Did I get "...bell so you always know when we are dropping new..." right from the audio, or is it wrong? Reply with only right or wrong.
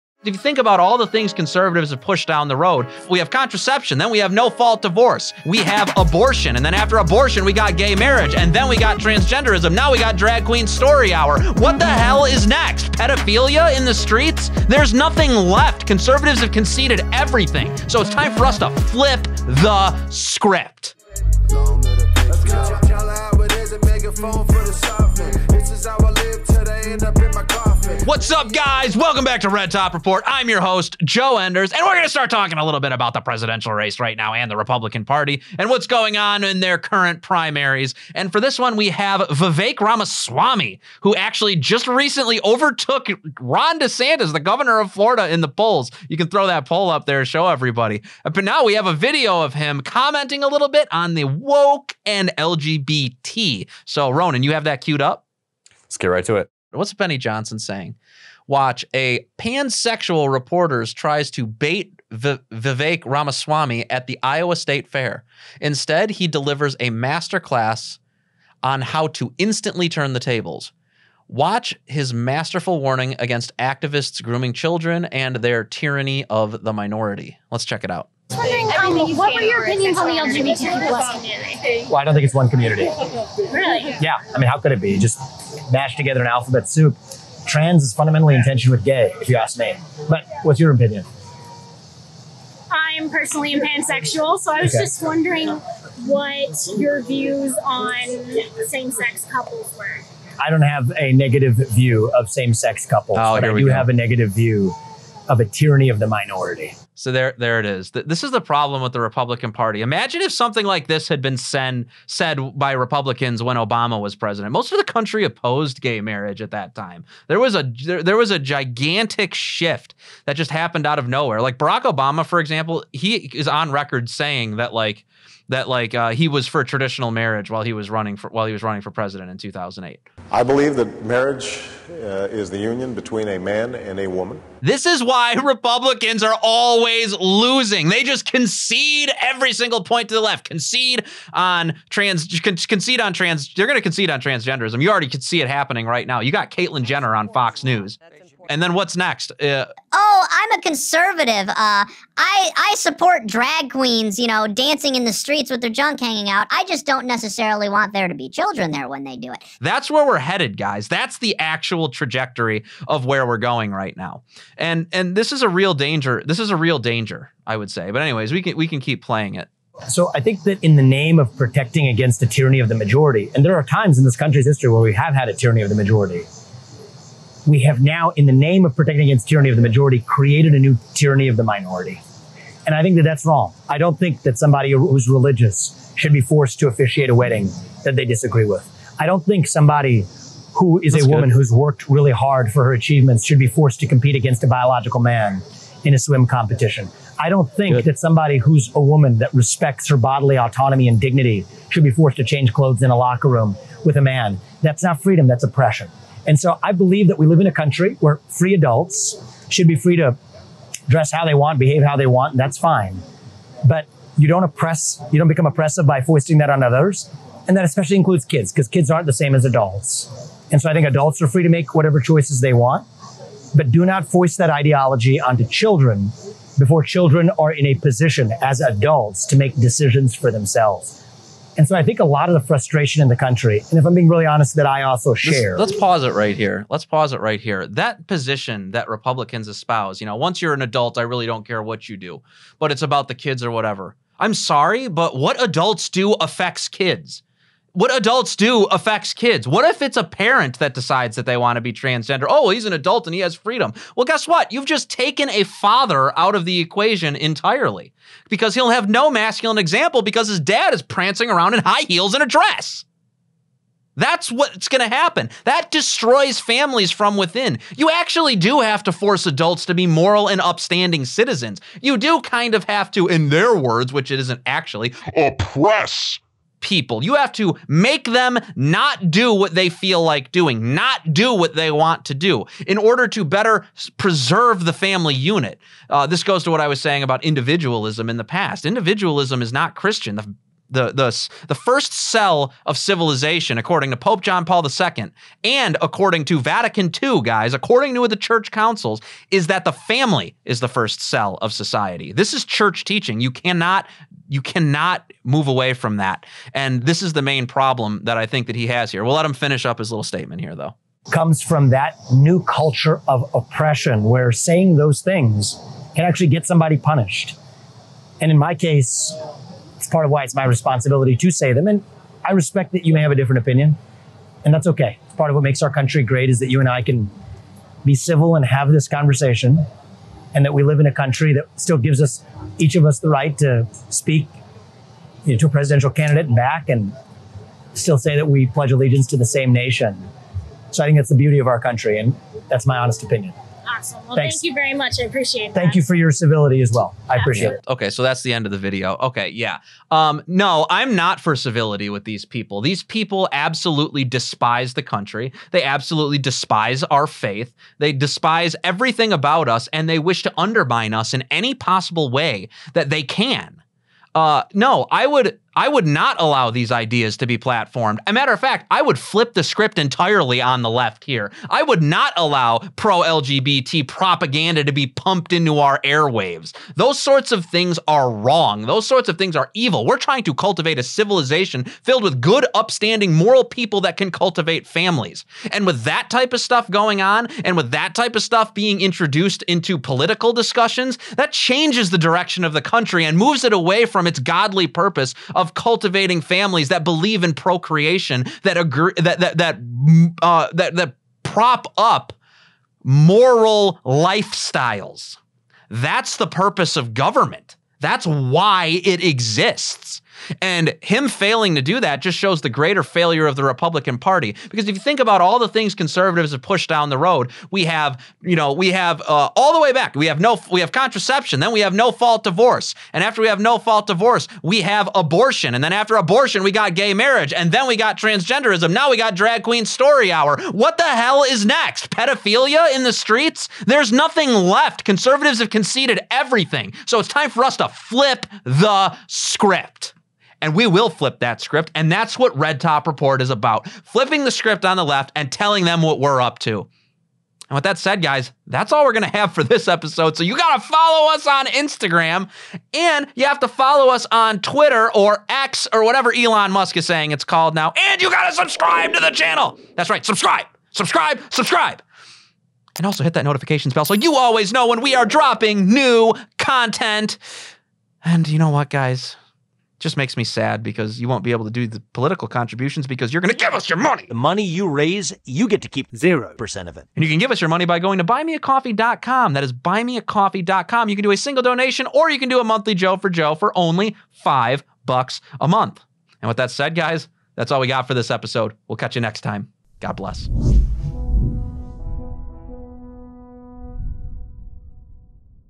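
right.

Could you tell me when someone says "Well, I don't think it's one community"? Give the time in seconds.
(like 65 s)
81 s.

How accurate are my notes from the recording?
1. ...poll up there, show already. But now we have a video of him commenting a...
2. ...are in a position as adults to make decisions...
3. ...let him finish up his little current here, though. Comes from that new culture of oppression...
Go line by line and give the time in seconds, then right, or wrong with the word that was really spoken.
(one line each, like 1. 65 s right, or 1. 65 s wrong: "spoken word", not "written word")
1. 46 s wrong: "everybody", not "already"
2. 227 s right
3. 309 s wrong: "statement", not "current".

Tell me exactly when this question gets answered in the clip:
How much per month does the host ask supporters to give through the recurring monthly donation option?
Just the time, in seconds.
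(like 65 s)
484 s.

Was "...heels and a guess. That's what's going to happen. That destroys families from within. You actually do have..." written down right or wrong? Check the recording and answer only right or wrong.
wrong.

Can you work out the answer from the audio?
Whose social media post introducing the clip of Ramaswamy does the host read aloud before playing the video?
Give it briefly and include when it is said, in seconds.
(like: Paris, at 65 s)
Benny Johnson, at 56 s.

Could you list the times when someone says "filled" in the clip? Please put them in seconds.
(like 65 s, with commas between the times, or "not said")
381 s.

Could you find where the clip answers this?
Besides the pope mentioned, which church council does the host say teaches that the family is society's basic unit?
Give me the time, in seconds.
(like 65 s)
296 s.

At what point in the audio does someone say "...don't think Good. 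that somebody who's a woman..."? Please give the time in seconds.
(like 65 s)
197 s.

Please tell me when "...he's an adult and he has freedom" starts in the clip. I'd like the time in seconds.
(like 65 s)
252 s.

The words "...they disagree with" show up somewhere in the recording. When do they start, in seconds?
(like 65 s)
187 s.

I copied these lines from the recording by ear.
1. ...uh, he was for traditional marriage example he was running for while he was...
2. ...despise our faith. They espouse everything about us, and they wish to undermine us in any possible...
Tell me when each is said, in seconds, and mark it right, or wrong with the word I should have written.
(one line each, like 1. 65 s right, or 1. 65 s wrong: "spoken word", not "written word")
1. 125 s wrong: "while", not "example"
2. 356 s wrong: "despise", not "espouse".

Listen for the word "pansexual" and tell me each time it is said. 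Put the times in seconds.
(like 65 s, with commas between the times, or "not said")
59 s, 93 s.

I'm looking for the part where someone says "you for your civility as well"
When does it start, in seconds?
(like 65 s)
345 s.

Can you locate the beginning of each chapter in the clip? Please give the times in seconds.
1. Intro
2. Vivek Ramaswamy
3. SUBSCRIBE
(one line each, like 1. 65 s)
1. 21 s
2. 77 s
3. 447 s.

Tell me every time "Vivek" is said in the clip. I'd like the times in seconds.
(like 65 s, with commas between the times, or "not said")
39 s, 62 s.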